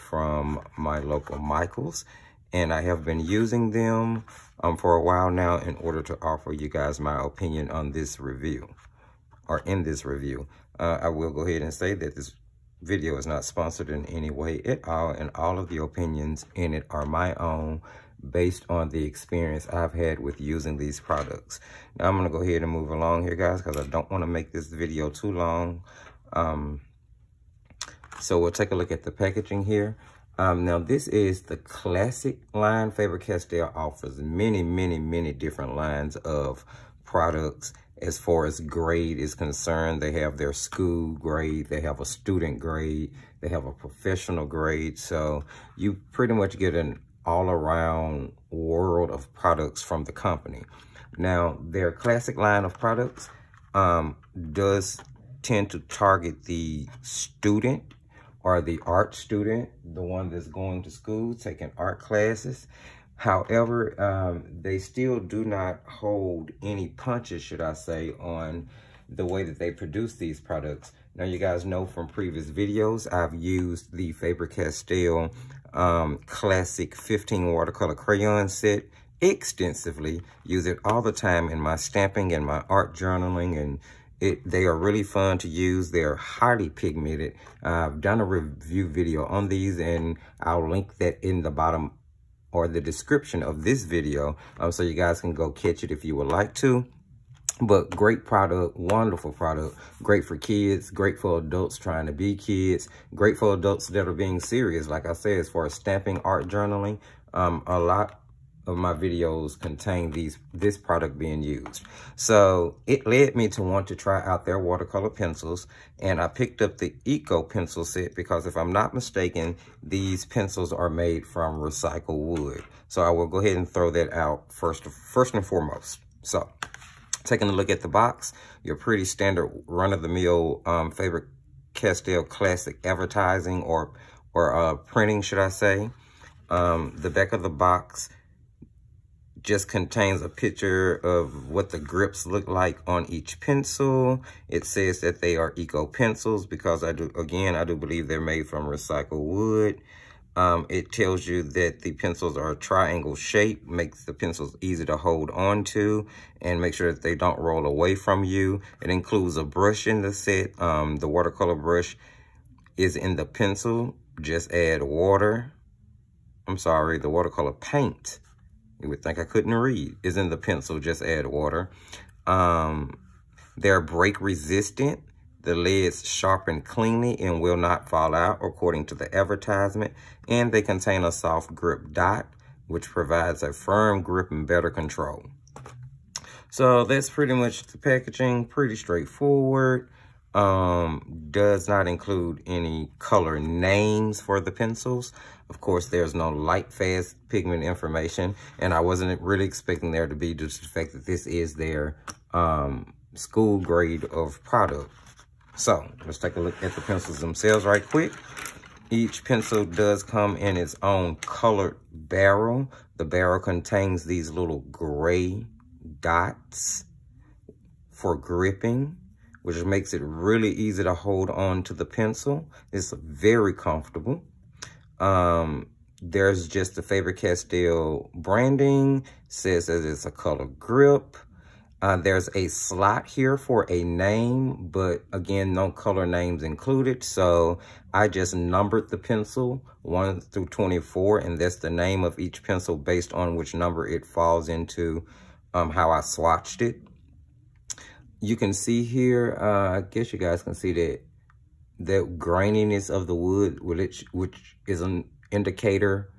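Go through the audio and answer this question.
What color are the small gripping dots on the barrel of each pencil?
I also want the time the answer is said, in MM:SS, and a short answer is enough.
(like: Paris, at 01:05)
gray, at 03:34.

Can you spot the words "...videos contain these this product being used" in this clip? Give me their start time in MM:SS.
01:48.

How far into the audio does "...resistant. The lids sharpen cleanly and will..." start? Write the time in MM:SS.
02:54.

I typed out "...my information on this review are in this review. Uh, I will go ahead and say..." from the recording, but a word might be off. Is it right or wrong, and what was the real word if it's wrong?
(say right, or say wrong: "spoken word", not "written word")
wrong: "opinion", not "information".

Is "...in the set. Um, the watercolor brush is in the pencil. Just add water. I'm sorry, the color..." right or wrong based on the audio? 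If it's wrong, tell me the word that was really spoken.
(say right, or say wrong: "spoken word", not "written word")
wrong: "watercolor", not "color".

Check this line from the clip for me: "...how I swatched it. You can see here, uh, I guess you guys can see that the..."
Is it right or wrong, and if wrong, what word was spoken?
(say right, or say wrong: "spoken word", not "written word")
right.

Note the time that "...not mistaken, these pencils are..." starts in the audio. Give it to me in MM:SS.
01:58.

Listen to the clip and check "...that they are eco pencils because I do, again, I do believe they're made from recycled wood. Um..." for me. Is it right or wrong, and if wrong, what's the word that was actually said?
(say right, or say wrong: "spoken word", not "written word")
right.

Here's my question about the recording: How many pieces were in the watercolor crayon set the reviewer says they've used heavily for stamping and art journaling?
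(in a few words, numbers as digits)
15.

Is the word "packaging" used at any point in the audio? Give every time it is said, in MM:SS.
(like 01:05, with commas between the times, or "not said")
00:29, 03:07.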